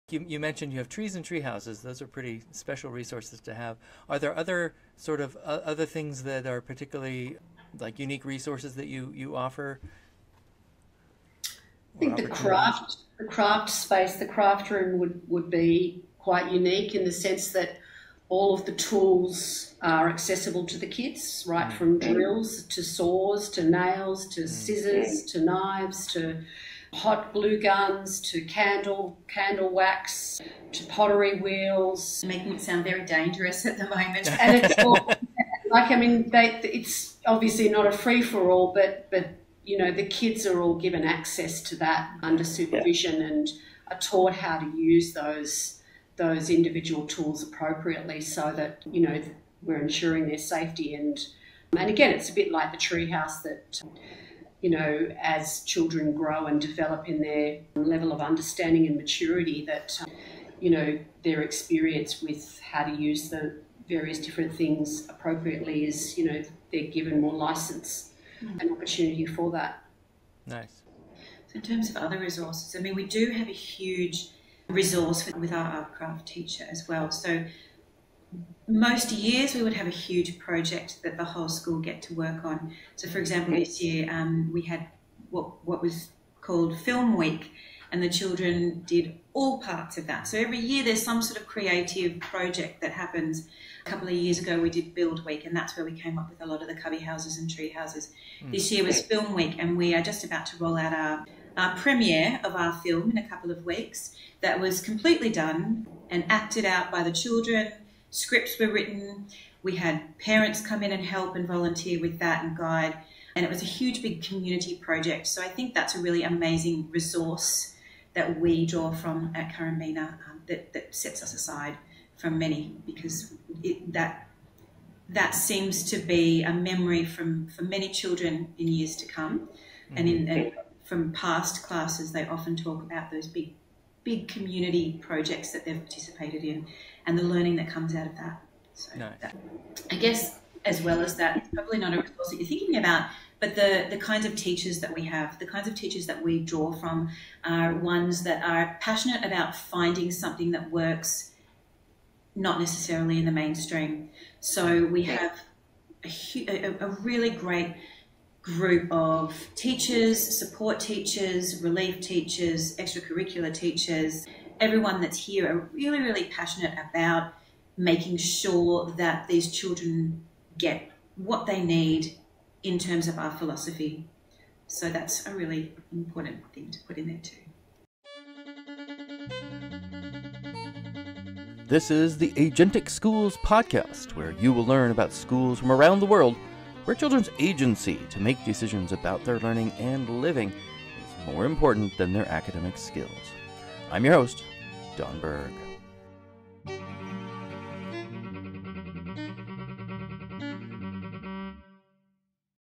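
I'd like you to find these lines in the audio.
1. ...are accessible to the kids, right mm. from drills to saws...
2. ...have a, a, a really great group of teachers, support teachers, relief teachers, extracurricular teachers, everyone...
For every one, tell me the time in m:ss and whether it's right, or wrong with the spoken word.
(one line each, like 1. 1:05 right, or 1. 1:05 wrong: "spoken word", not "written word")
1. 0:19 right
2. 2:35 right.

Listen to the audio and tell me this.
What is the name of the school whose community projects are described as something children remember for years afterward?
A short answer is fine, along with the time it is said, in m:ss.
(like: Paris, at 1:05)
Currambena, at 1:59.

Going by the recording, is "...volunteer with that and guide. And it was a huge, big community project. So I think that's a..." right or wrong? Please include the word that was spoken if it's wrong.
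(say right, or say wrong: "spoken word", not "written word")
right.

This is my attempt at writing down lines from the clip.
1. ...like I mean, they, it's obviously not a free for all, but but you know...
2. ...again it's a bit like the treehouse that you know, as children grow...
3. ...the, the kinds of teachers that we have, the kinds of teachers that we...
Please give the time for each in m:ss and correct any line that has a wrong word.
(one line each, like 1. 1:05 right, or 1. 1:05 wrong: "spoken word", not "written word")
1. 0:35 right
2. 0:51 right
3. 2:23 right.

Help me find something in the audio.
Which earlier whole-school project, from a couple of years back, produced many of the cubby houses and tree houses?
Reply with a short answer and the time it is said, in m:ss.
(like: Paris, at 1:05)
Build Week, at 1:34.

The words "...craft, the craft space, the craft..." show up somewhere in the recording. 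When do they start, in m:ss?
0:12.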